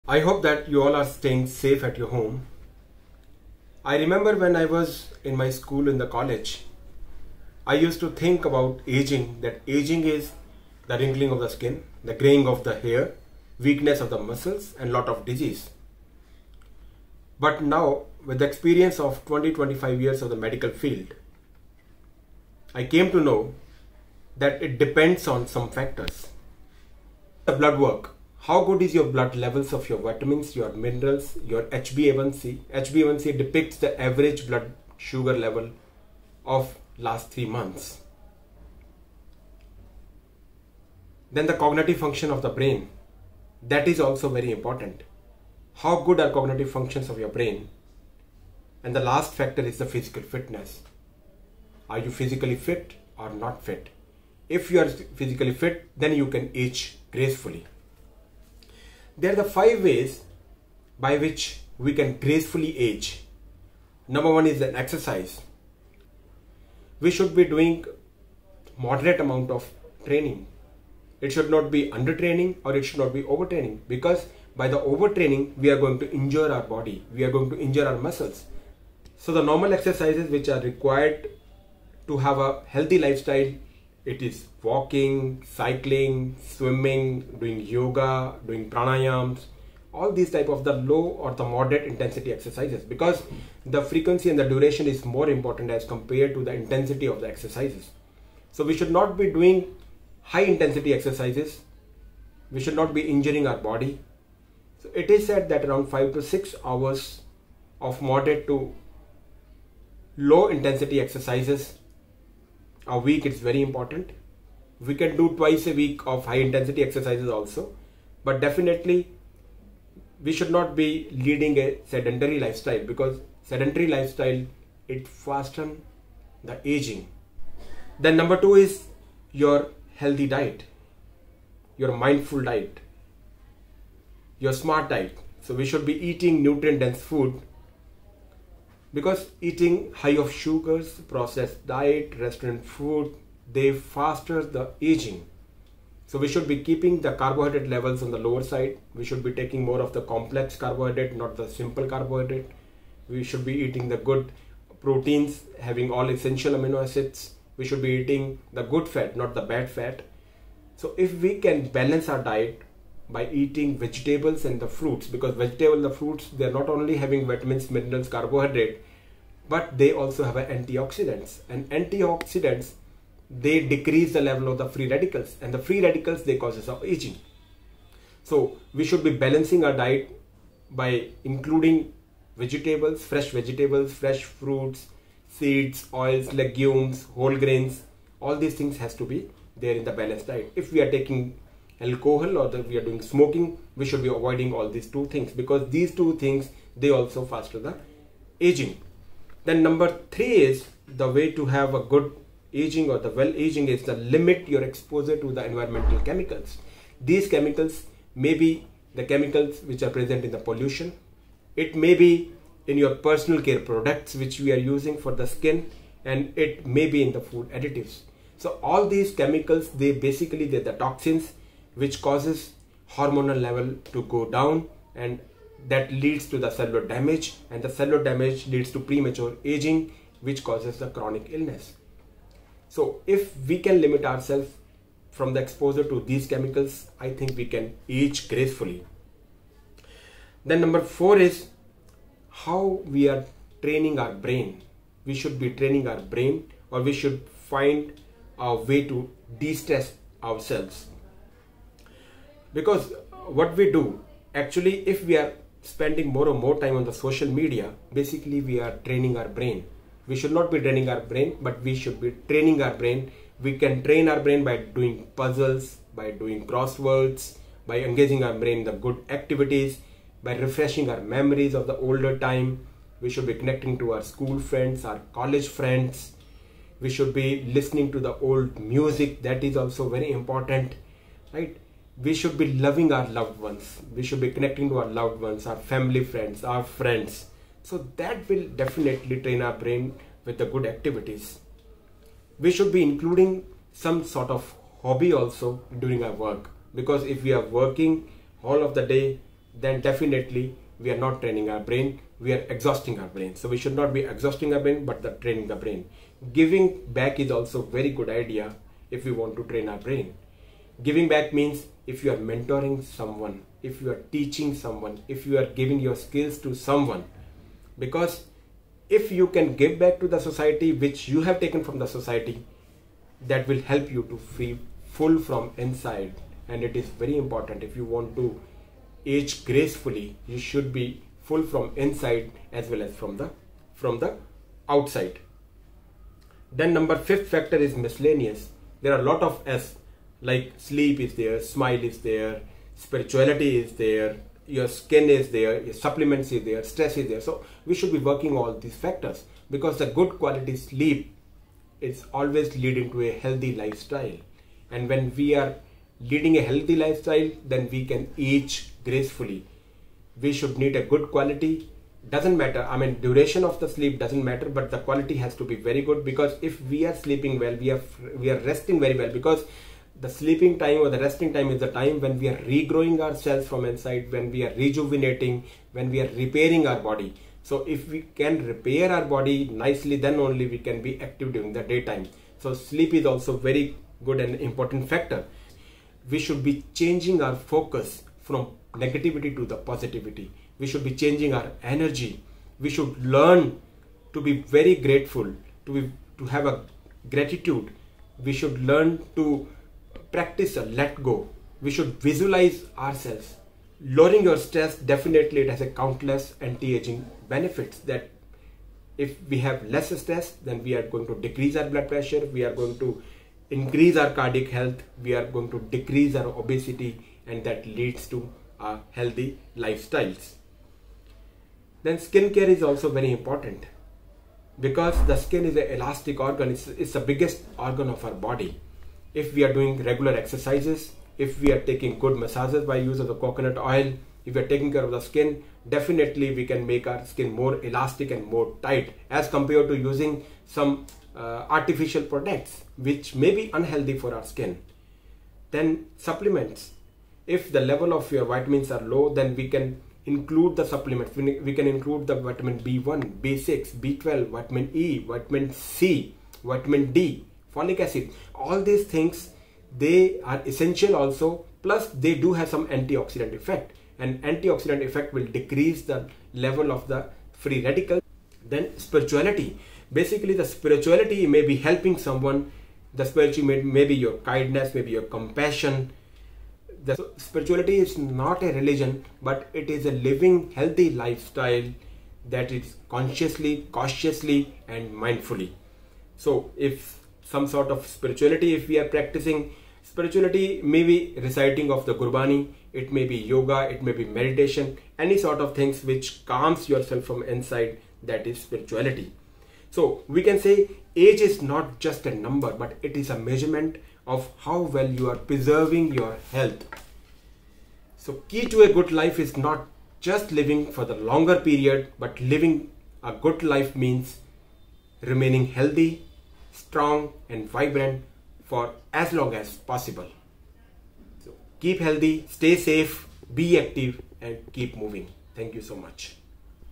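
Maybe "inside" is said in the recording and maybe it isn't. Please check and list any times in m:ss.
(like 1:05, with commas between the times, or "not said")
5:25, 5:31, 6:13, 8:17.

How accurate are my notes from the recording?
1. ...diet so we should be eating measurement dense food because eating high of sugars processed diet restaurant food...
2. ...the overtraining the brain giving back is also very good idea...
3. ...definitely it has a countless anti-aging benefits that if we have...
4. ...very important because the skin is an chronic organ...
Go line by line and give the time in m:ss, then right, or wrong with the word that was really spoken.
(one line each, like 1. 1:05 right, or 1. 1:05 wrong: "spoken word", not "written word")
1. 2:14 wrong: "nutrient", not "measurement"
2. 5:05 wrong: "training", not "overtraining"
3. 6:44 right
4. 7:02 wrong: "elastic", not "chronic".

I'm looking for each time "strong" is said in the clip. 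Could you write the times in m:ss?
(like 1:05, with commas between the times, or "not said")
8:36.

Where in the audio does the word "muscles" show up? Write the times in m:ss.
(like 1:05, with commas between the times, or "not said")
0:14, 1:17.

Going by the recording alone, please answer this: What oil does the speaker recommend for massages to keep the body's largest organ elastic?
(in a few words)
coconut oil.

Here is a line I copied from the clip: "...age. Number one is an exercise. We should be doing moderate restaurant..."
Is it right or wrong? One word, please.
wrong.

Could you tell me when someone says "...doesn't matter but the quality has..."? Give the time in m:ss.
6:03.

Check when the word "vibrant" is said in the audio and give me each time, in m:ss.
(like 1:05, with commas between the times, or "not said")
8:37.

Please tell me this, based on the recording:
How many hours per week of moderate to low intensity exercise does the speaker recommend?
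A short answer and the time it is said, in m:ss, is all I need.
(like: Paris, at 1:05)
5 to 6 hours, at 1:45.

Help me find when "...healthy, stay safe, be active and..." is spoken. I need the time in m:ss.
8:41.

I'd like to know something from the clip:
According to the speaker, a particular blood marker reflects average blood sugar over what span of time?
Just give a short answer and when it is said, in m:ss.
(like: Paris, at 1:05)
3 months, at 0:36.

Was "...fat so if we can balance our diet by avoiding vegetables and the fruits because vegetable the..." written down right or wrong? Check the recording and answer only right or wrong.
wrong.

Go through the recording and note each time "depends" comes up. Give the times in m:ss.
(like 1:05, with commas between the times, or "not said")
0:24.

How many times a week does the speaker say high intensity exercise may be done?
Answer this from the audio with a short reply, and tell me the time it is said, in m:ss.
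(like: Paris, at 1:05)
twice, at 1:55.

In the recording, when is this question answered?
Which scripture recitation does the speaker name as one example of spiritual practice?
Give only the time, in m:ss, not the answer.
8:11.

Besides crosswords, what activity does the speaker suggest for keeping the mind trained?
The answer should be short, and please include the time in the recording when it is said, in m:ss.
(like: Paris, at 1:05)
puzzles, at 4:25.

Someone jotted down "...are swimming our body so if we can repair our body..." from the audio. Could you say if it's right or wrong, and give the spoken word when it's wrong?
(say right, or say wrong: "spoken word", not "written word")
wrong: "repairing", not "swimming".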